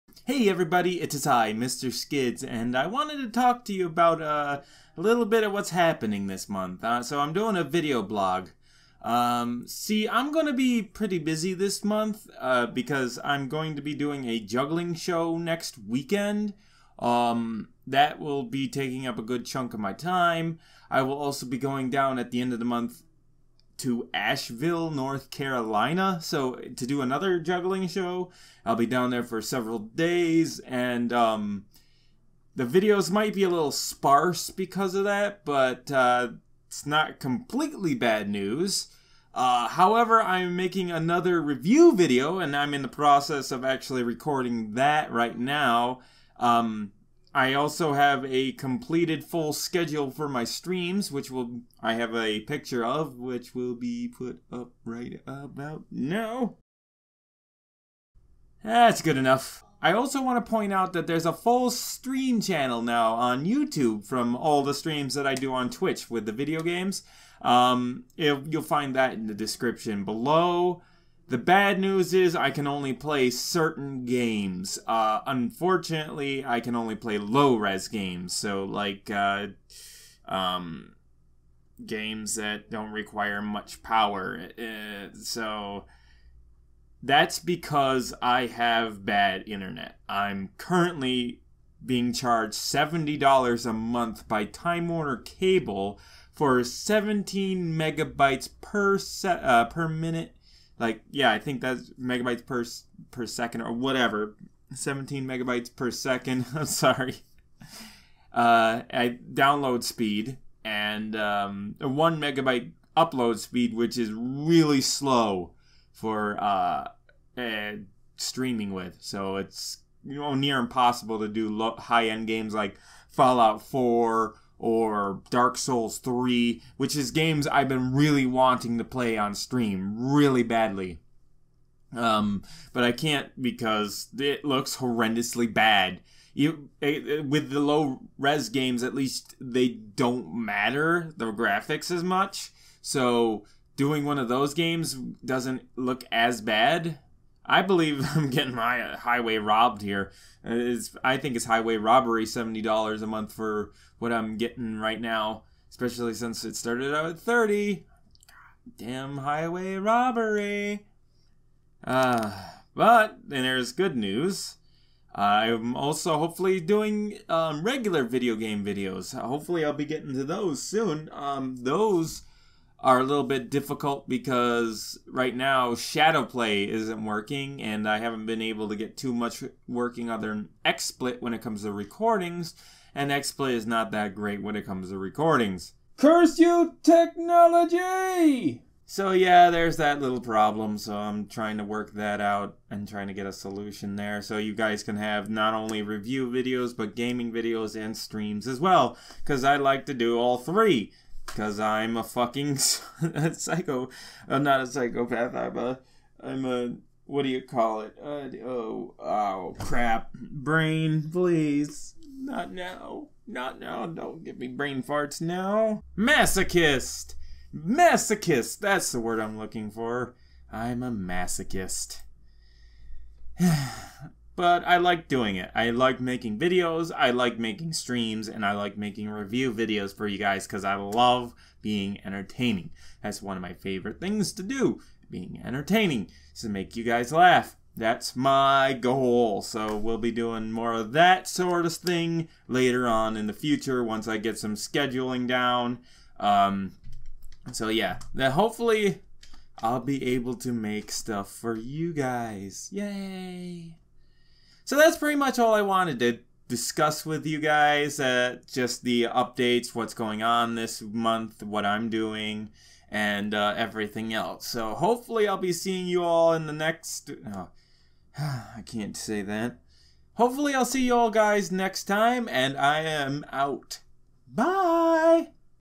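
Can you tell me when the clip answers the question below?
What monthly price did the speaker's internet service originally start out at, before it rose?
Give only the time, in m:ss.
2:37.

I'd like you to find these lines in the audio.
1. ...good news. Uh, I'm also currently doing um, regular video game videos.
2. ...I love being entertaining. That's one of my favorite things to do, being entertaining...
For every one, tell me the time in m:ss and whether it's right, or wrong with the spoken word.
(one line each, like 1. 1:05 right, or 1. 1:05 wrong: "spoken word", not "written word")
1. 2:43 wrong: "hopefully", not "currently"
2. 3:50 right.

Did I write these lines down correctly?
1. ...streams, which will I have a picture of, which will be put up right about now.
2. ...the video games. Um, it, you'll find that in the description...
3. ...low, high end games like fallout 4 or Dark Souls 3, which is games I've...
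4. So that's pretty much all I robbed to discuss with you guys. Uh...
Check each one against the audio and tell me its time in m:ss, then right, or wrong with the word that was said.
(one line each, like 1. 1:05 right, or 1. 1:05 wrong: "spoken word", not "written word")
1. 0:50 right
2. 1:06 right
3. 2:01 right
4. 4:14 wrong: "wanted", not "robbed".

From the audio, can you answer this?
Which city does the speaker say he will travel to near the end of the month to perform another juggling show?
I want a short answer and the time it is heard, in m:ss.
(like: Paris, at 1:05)
Asheville, at 0:24.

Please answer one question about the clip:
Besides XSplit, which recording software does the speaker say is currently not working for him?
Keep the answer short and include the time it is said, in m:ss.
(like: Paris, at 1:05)
ShadowPlay, at 2:55.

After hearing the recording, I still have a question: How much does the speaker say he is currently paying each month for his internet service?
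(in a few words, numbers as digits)
$70.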